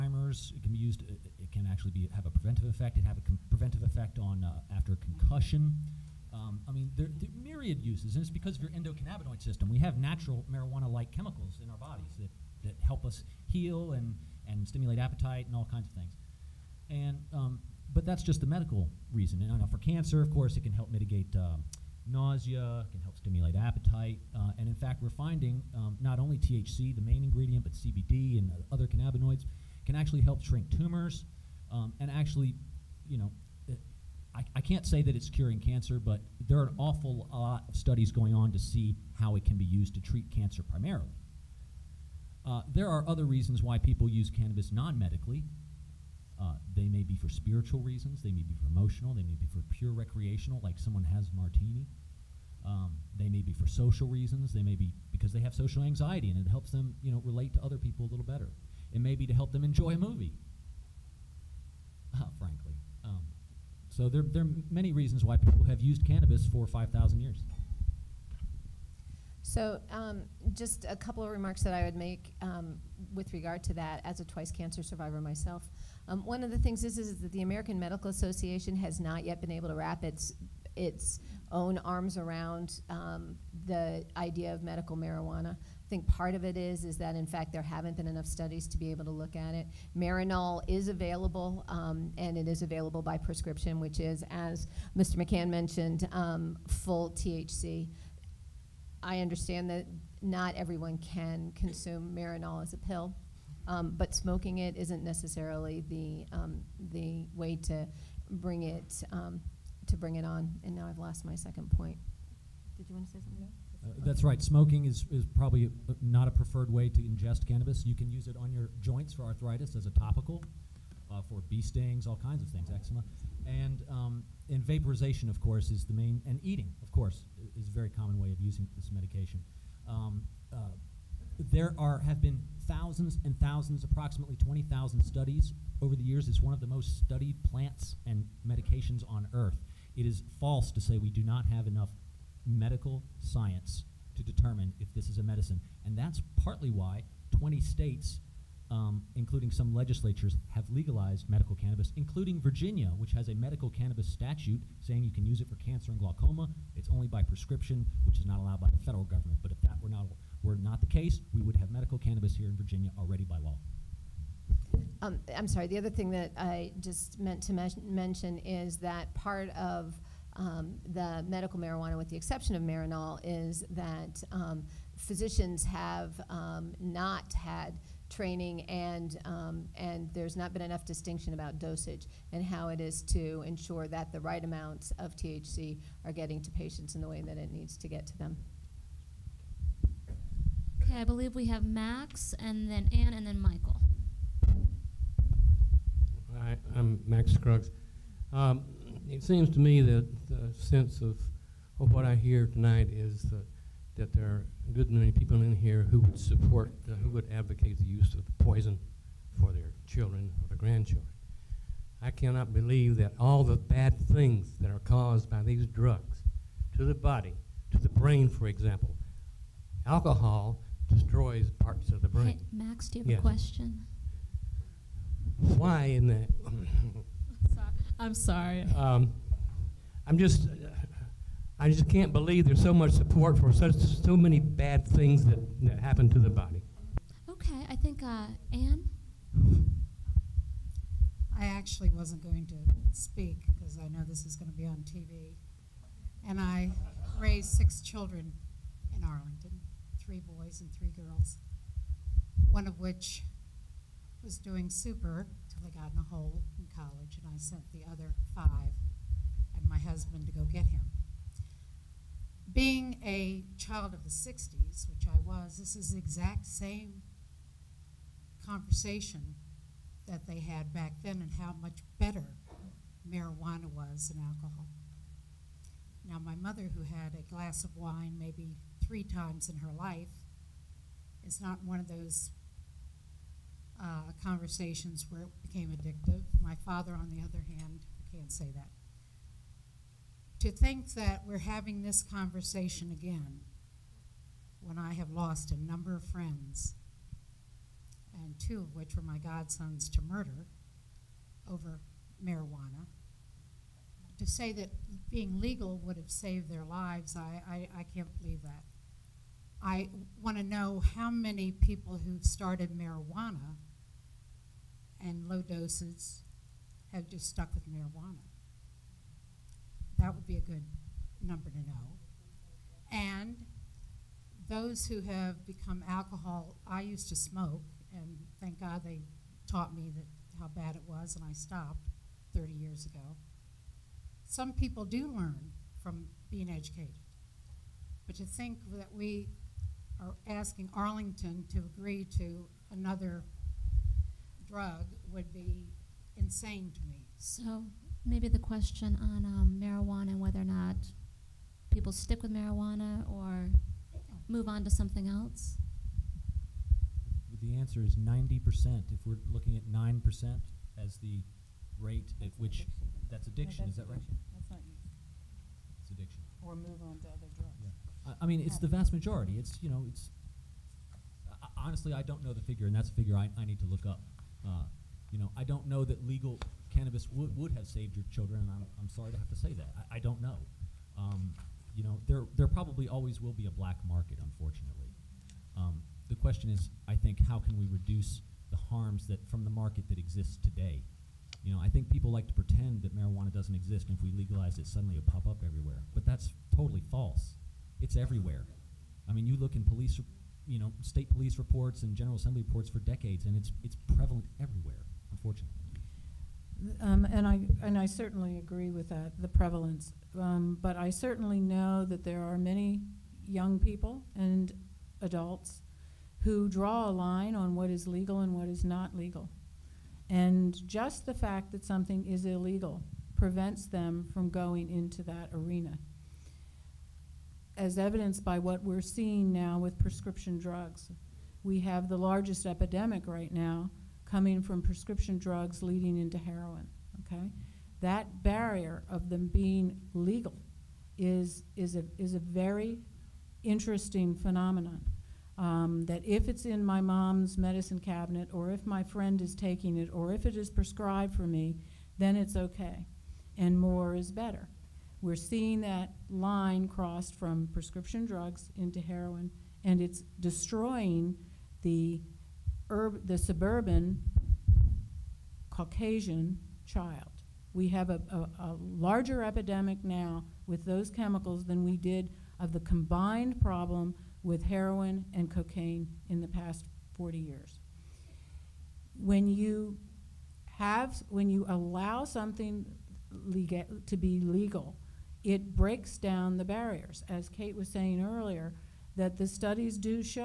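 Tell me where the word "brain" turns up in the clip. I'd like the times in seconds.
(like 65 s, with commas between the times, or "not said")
217 s, 222 s.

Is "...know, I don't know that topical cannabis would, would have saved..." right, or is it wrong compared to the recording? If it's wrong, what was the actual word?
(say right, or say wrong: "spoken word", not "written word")
wrong: "legal", not "topical".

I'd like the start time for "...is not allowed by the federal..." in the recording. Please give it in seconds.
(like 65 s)
158 s.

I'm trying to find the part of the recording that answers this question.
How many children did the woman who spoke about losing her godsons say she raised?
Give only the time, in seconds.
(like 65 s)
247 s.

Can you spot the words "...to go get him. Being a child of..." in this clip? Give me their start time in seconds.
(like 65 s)
260 s.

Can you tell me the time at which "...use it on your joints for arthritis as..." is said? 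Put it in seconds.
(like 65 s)
118 s.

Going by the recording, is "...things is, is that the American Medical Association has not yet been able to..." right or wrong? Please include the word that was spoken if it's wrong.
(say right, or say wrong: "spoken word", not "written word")
right.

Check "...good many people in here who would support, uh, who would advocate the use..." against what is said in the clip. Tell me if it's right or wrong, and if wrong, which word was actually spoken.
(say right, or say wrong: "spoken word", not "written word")
right.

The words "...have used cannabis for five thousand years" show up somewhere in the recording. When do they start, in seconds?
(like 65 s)
65 s.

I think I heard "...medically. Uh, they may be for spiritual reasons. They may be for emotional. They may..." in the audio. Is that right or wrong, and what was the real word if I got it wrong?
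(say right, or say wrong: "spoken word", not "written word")
right.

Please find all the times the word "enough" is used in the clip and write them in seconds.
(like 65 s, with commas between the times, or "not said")
88 s, 141 s, 180 s.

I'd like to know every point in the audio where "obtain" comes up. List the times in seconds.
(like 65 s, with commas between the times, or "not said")
not said.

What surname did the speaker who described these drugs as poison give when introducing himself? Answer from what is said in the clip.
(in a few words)
Scruggs.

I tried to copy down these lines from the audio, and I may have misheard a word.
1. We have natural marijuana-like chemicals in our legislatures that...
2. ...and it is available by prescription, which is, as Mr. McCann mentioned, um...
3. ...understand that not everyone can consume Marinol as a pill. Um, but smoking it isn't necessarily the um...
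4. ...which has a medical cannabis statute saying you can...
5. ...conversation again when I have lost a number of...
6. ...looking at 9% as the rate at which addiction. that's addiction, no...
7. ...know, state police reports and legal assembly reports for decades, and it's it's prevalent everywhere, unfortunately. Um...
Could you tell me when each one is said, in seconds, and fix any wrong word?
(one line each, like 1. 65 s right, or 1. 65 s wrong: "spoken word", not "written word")
1. 9 s wrong: "bodies", not "legislatures"
2. 92 s right
3. 99 s right
4. 152 s right
5. 292 s right
6. 359 s right
7. 400 s wrong: "general", not "legal".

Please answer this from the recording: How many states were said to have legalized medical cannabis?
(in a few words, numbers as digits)
20.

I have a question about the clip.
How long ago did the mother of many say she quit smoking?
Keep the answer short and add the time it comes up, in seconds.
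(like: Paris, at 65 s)
30 years ago, at 332 s.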